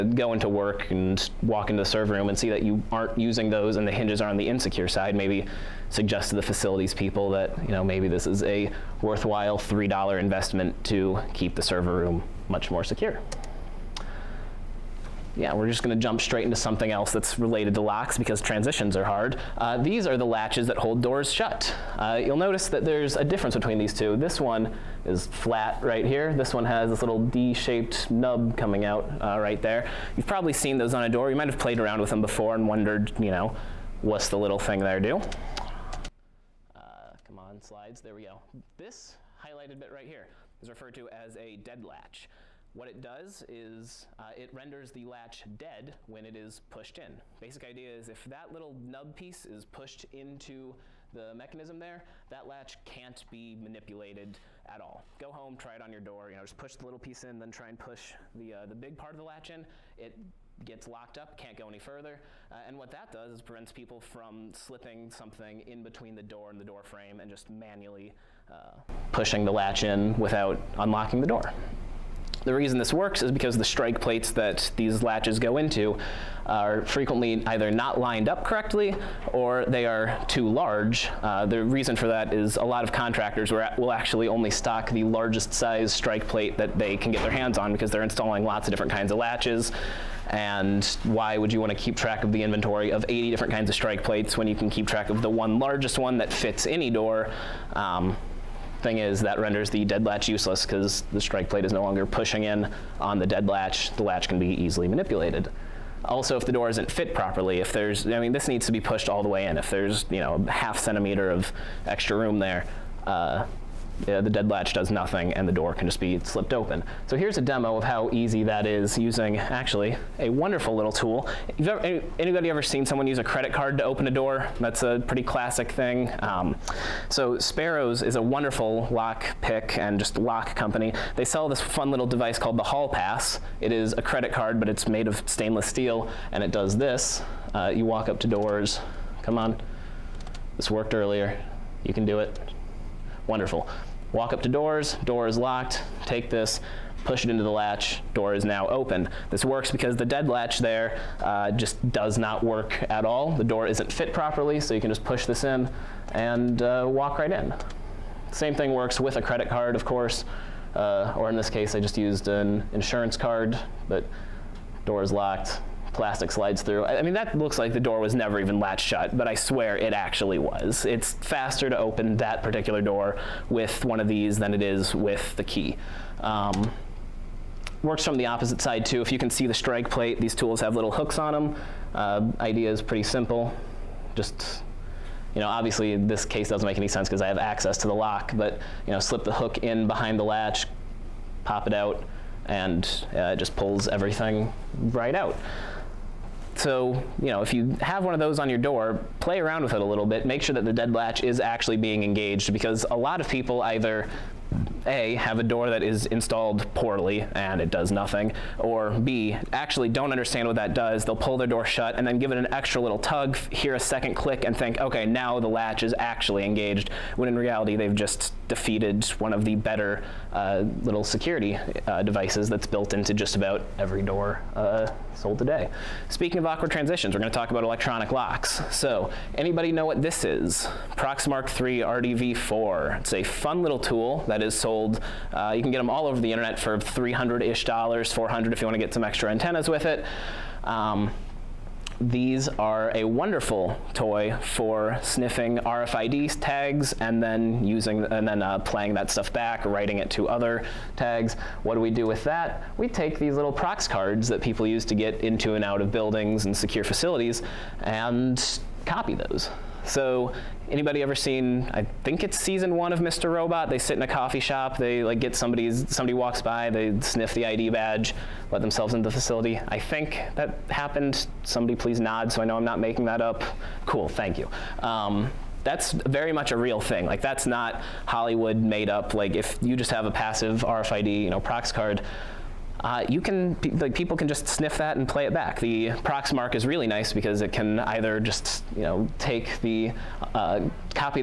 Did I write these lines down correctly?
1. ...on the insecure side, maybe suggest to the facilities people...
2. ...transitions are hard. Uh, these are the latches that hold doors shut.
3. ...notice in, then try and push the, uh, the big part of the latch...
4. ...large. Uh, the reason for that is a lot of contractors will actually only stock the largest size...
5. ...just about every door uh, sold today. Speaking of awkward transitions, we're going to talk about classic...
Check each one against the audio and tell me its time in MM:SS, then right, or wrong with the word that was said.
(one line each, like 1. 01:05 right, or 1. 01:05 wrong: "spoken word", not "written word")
1. 00:04 right
2. 00:18 right
3. 00:56 wrong: "piece", not "notice"
4. 01:20 right
5. 03:43 wrong: "electronic", not "classic".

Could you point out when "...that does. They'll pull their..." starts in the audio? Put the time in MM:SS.
03:30.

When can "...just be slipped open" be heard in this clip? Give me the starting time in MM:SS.
01:55.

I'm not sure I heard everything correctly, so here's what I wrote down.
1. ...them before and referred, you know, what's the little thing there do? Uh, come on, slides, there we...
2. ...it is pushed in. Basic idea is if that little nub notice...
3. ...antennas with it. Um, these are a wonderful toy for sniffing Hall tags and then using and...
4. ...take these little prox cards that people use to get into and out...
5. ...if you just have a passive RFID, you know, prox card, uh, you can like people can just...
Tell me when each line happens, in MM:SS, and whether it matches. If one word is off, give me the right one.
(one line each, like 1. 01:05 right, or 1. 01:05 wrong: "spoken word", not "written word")
1. 00:32 wrong: "wondered", not "referred"
2. 00:46 wrong: "piece", not "notice"
3. 03:59 wrong: "RFID", not "Hall"
4. 04:12 right
5. 04:39 right.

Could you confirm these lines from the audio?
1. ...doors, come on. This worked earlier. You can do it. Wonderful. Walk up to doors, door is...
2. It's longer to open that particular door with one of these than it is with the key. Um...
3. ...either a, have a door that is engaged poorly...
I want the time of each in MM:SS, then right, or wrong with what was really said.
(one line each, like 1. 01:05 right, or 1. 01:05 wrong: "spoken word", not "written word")
1. 02:18 right
2. 02:50 wrong: "faster", not "longer"
3. 03:23 wrong: "installed", not "engaged".